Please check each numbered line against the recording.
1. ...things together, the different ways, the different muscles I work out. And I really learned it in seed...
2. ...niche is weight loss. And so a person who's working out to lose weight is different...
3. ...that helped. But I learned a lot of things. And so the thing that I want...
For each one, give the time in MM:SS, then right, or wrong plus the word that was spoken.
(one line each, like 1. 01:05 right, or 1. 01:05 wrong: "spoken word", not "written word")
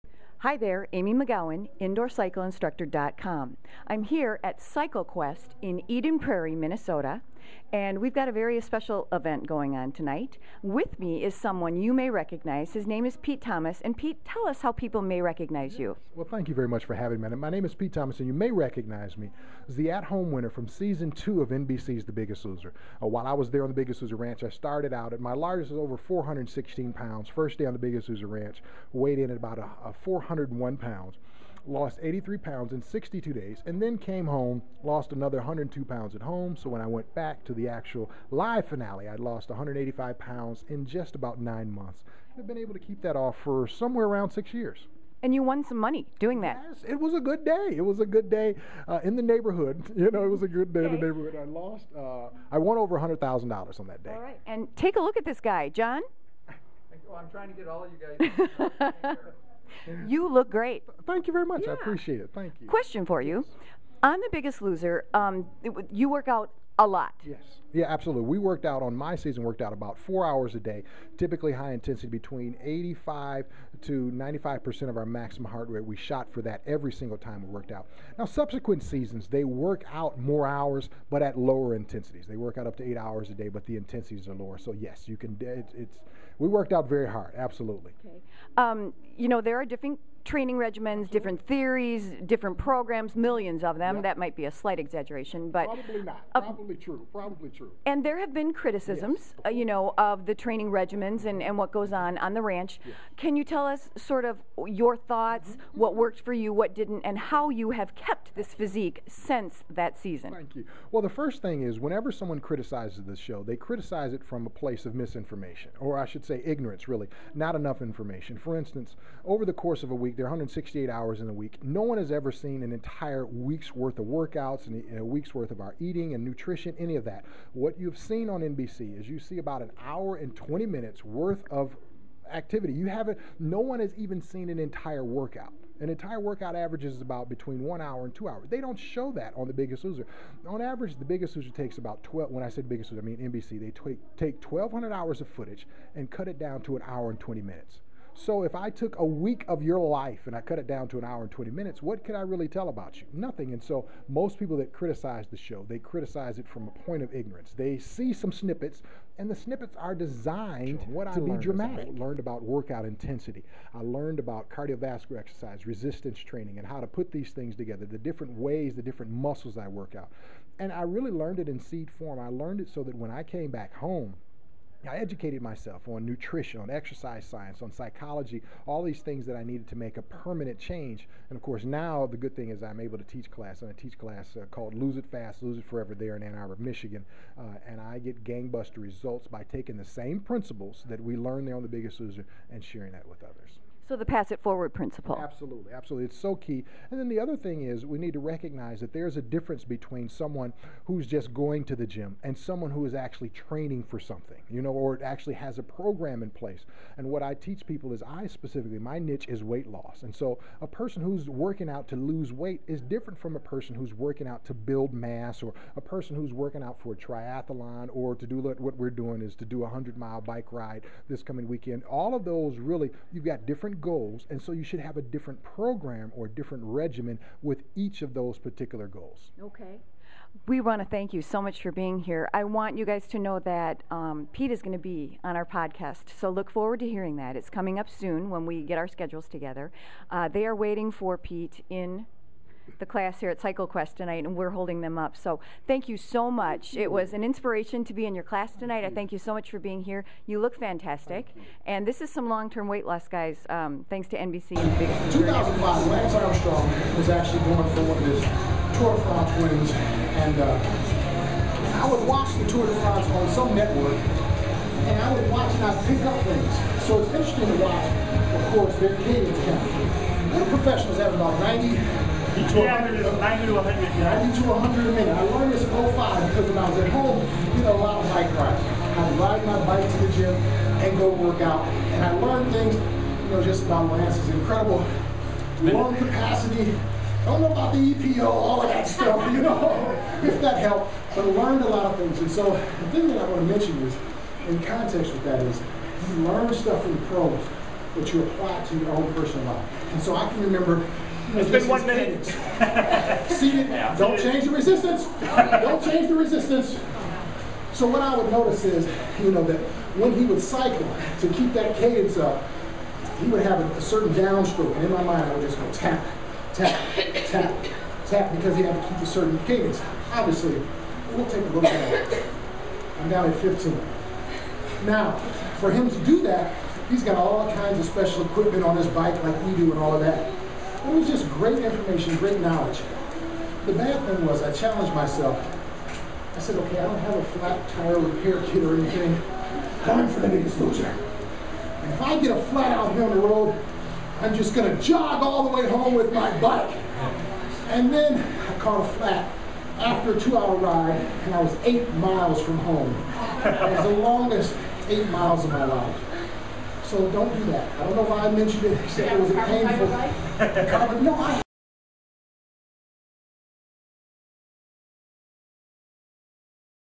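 1. 02:47 right
2. 03:28 right
3. 04:50 right.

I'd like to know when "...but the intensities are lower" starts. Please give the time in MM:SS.
01:23.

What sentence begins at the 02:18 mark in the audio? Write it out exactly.
They don't show that on The Biggest Loser.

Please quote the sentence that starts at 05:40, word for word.
And if I get a flat out here on the road, I'm just gonna jog all the way home with my bike.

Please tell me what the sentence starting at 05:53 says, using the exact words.
It was the longest eight miles of my life.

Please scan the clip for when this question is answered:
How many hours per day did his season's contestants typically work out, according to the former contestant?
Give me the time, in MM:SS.
01:09.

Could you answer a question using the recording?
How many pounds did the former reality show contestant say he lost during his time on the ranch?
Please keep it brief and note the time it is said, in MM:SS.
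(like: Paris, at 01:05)
83 pounds, at 00:32.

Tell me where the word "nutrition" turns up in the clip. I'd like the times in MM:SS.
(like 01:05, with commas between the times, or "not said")
02:06, 02:56.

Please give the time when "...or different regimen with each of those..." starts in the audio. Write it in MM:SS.
03:46.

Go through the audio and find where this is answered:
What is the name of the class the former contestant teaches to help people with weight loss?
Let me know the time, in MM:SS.
03:04.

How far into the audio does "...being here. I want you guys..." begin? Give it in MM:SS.
03:51.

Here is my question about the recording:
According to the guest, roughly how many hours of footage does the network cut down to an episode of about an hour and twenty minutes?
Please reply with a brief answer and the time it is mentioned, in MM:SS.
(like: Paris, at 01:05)
1,200 hours, at 02:24.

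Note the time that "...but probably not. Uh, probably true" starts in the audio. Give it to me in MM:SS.
01:35.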